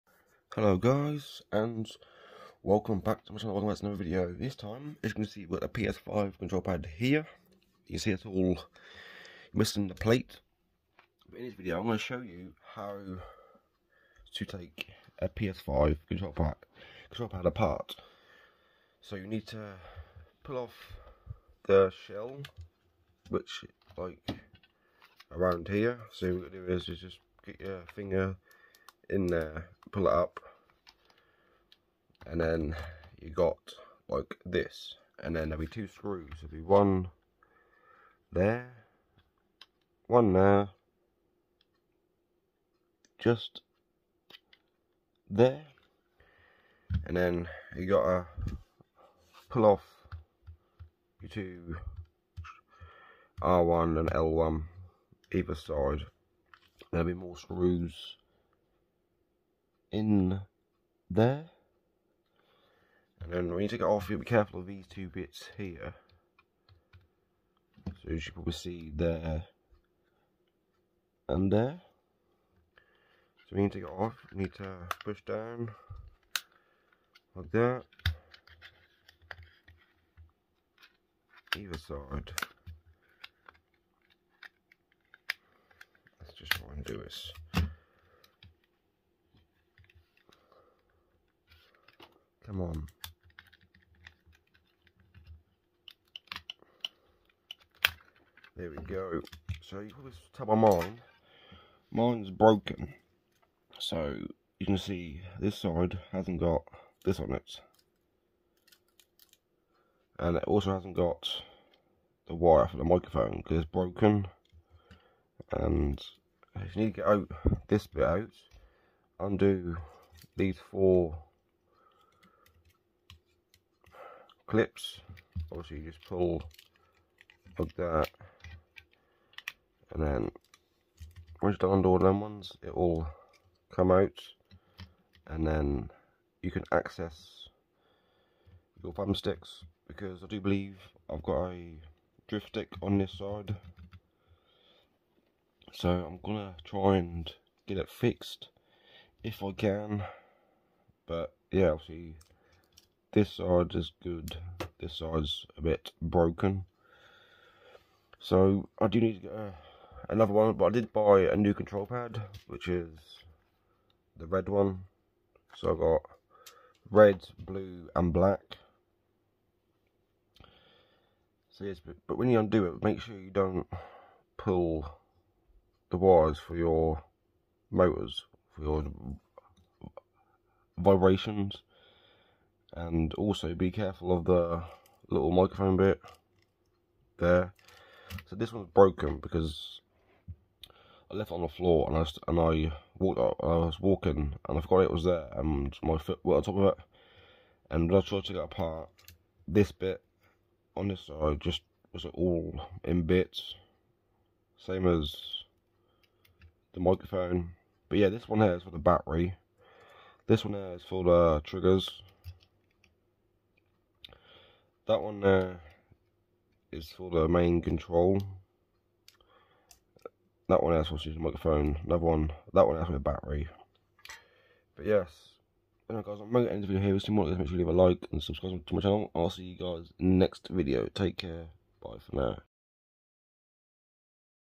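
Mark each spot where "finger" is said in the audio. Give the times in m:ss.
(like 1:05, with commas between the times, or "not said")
0:27.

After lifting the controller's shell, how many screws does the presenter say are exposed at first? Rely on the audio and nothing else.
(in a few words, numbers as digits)
2.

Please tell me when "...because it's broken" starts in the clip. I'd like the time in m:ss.
1:53.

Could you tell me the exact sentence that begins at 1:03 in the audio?
And then when you take it off, you'll be careful of these two bits here.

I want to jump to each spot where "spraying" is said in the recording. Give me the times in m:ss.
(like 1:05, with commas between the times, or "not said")
not said.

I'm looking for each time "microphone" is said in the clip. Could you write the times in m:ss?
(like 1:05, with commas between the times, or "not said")
1:52, 3:05, 3:26, 3:41.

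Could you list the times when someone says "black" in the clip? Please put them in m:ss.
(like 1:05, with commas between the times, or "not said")
2:48.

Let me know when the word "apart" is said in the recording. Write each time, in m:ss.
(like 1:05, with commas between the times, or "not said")
0:17, 3:18.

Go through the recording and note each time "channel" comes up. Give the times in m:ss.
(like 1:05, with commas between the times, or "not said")
0:03, 3:48.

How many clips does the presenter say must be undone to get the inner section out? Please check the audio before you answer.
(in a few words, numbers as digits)
4.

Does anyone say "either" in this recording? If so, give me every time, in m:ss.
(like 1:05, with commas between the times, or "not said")
0:55, 1:21.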